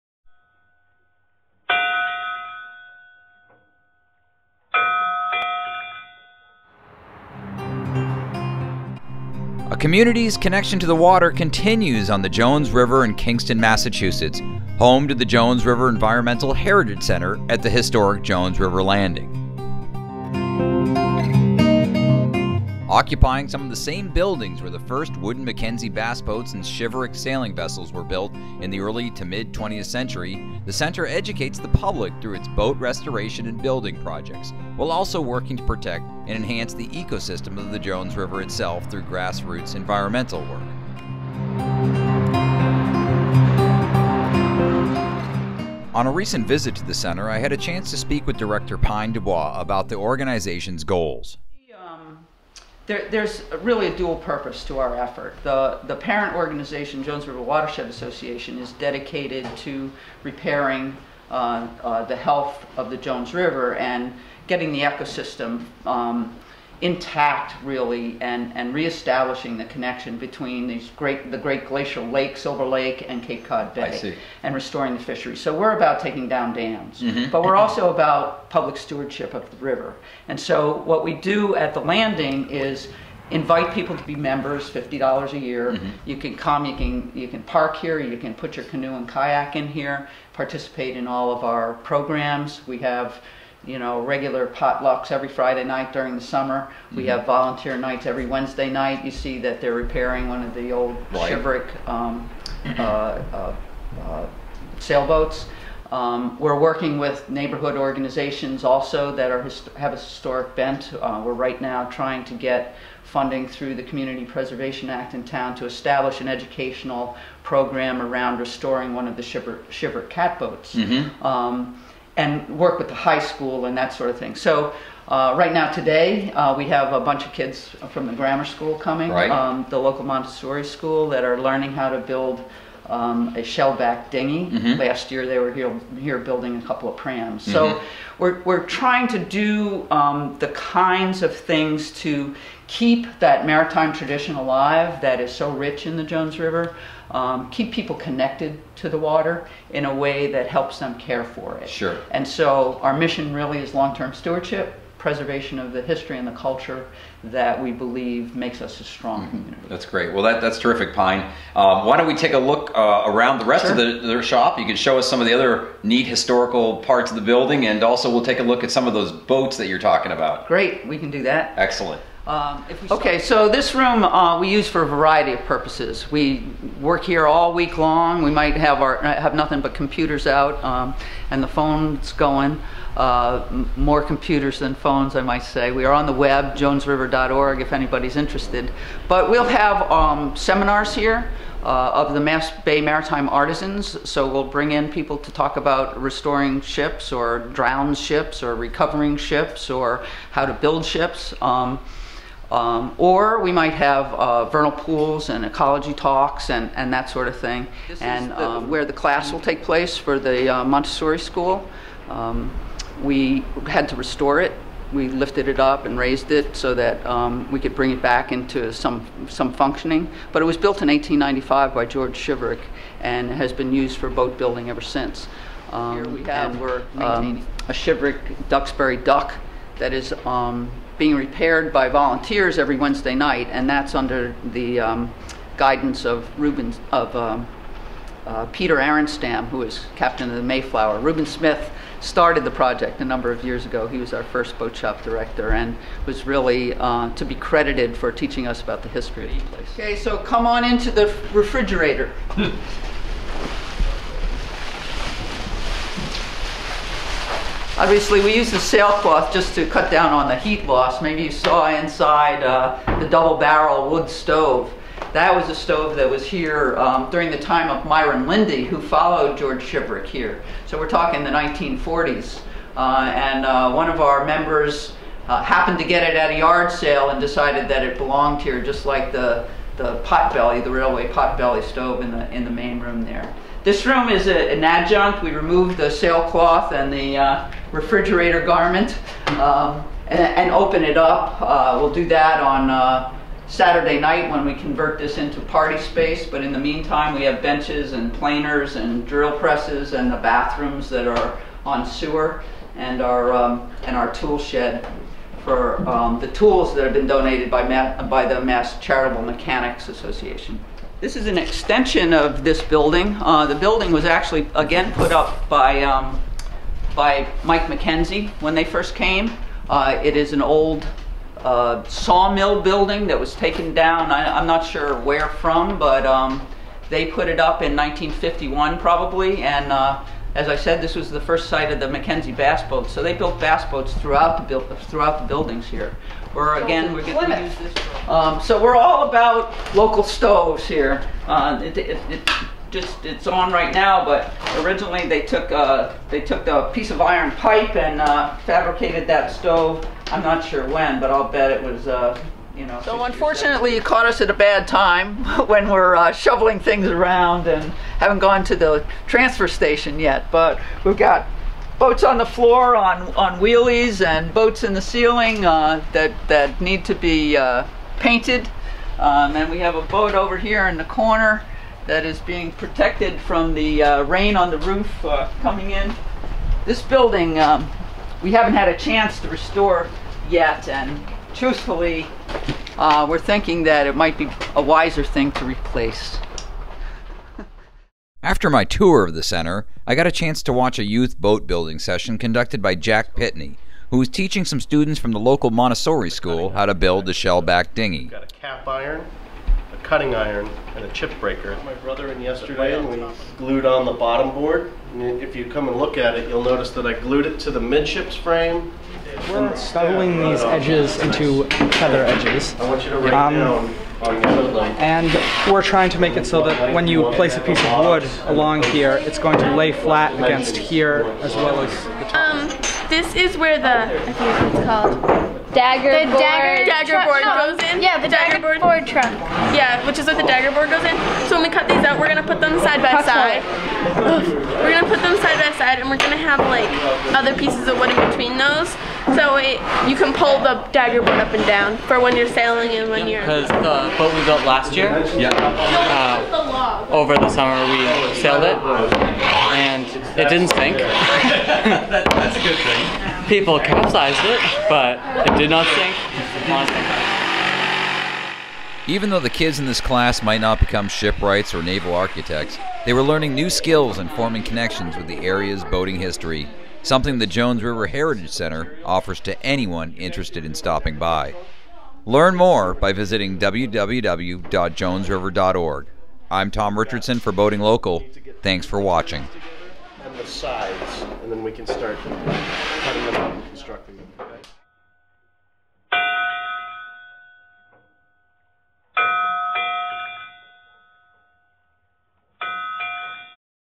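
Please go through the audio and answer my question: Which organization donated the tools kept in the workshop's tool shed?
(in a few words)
Mass Charitable Mechanics Association.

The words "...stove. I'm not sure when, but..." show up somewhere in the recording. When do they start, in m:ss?
5:49.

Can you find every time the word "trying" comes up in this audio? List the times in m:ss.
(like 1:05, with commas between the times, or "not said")
1:51, 2:18, 6:55.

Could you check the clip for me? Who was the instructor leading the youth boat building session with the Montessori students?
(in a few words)
Jack Pitney.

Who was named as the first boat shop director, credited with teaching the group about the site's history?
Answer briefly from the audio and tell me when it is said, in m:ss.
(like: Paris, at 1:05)
Reuben Smith, at 4:00.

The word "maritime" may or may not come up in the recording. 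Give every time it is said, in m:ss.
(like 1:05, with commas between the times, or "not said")
2:23, 3:12.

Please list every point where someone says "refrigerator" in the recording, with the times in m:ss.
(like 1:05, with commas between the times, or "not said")
4:11, 4:47.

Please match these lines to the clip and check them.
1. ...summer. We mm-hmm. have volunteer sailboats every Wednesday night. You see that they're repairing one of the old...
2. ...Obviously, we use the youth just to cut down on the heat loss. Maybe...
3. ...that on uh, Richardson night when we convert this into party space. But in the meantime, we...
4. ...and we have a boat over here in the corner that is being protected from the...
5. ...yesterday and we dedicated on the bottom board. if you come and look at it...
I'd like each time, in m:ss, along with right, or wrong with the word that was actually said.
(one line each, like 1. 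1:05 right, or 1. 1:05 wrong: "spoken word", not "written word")
1. 1:36 wrong: "nights", not "sailboats"
2. 4:17 wrong: "sailcloth", not "youth"
3. 4:52 wrong: "Saturday", not "Richardson"
4. 6:09 right
5. 6:42 wrong: "glued", not "dedicated".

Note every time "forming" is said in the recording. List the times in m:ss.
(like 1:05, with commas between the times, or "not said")
7:44.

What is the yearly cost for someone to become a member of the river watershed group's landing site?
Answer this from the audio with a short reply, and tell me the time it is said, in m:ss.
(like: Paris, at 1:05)
$50, at 1:24.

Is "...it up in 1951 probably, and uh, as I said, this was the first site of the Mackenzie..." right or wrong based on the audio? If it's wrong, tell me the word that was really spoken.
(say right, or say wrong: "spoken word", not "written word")
right.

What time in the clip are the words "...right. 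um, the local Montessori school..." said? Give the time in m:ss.
2:09.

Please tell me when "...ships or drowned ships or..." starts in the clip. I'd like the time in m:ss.
3:16.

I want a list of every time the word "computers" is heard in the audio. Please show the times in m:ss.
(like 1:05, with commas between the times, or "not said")
2:59, 3:04.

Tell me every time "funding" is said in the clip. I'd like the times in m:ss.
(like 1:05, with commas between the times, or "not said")
1:53.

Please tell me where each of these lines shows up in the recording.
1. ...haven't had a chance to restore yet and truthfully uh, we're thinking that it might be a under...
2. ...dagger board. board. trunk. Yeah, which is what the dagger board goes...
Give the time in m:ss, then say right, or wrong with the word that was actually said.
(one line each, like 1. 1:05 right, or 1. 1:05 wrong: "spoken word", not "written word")
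1. 6:18 wrong: "wiser", not "under"
2. 7:08 right.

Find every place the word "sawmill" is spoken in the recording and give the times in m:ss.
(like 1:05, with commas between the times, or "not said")
5:21.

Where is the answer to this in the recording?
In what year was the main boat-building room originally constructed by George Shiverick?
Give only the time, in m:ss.
3:40.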